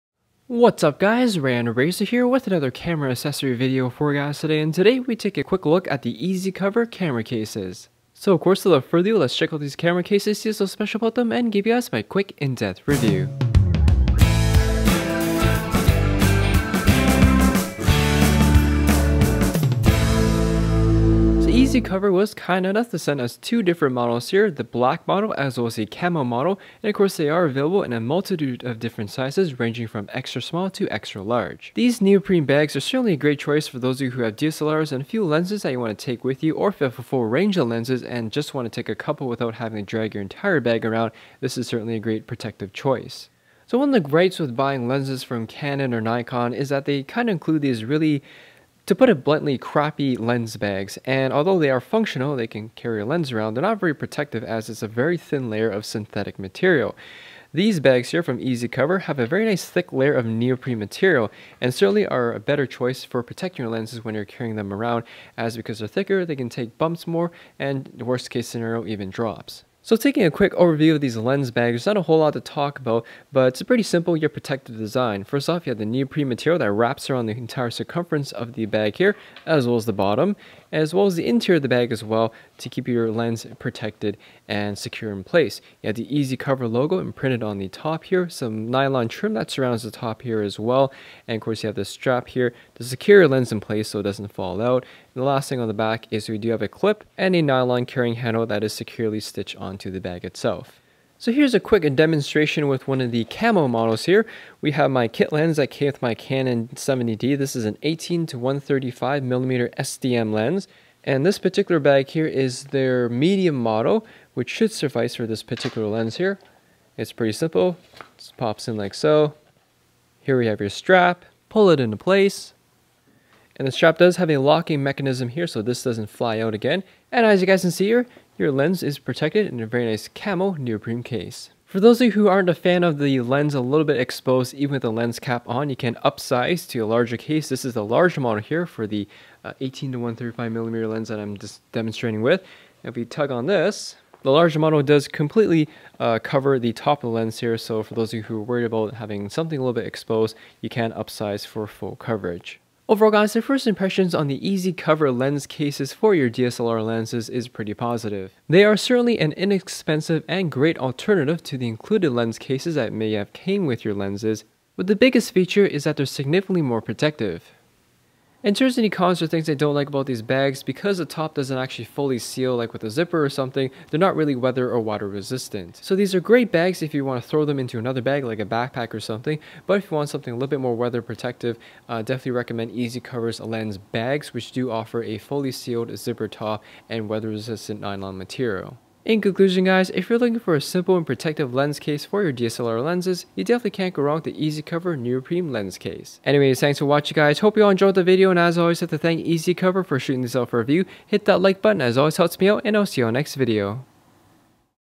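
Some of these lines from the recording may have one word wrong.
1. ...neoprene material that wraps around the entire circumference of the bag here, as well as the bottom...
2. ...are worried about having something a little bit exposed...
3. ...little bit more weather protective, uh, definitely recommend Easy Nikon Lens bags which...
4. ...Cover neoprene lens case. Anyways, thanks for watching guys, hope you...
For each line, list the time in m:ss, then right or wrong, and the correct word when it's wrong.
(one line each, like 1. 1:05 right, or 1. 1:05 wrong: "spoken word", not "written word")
1. 1:15 right
2. 2:28 right
3. 3:00 wrong: "Covers", not "Nikon"
4. 3:14 right.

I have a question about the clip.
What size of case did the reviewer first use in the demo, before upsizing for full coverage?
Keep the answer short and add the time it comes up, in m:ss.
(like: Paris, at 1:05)
Medium, at 1:53.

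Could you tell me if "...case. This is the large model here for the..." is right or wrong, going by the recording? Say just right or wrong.
right.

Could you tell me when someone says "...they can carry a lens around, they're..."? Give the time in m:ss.
0:52.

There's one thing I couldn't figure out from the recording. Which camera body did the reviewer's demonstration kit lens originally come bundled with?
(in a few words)
Canon 70D.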